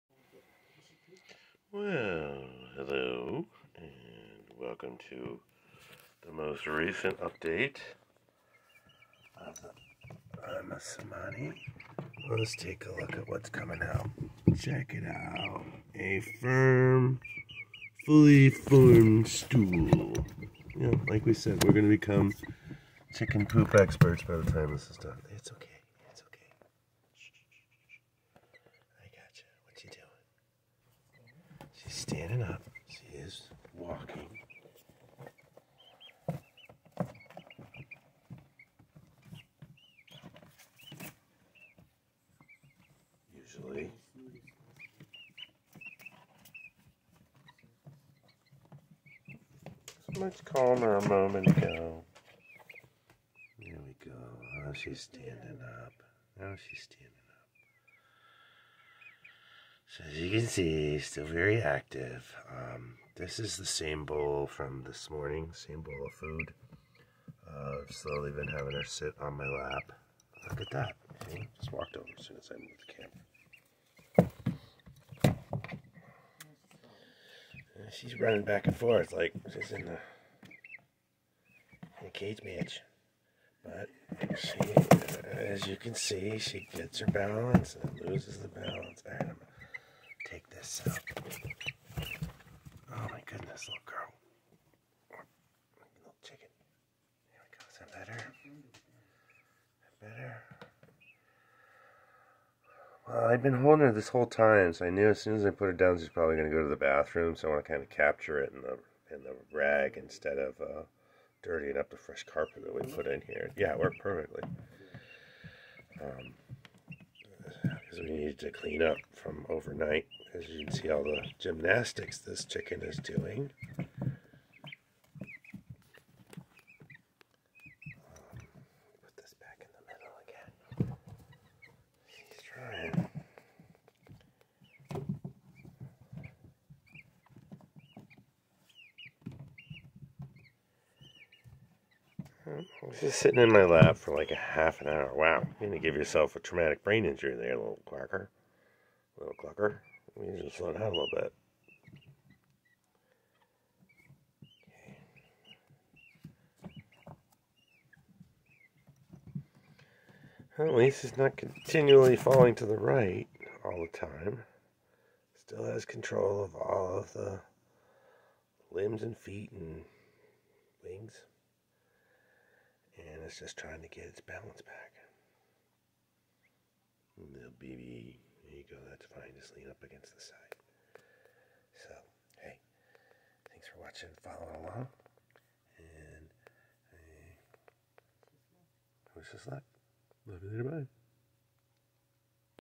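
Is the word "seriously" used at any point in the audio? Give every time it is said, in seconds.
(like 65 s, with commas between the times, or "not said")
not said.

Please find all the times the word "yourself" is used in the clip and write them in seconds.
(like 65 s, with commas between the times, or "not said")
145 s.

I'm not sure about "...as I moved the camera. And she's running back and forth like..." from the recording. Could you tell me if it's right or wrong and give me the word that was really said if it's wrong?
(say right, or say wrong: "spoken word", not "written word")
right.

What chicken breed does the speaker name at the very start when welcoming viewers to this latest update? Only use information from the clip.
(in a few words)
Ayam Cemani.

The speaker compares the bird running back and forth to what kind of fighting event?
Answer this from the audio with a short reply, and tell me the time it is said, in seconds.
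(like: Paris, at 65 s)
Cage match, at 82 s.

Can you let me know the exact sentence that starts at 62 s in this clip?
Um, this is the same bowl from this morning, same bowl of food.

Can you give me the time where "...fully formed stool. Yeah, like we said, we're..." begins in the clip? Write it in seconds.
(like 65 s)
18 s.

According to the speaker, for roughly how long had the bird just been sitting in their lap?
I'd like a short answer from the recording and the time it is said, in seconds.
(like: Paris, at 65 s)
Half an hour, at 144 s.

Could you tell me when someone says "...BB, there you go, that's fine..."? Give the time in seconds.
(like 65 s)
177 s.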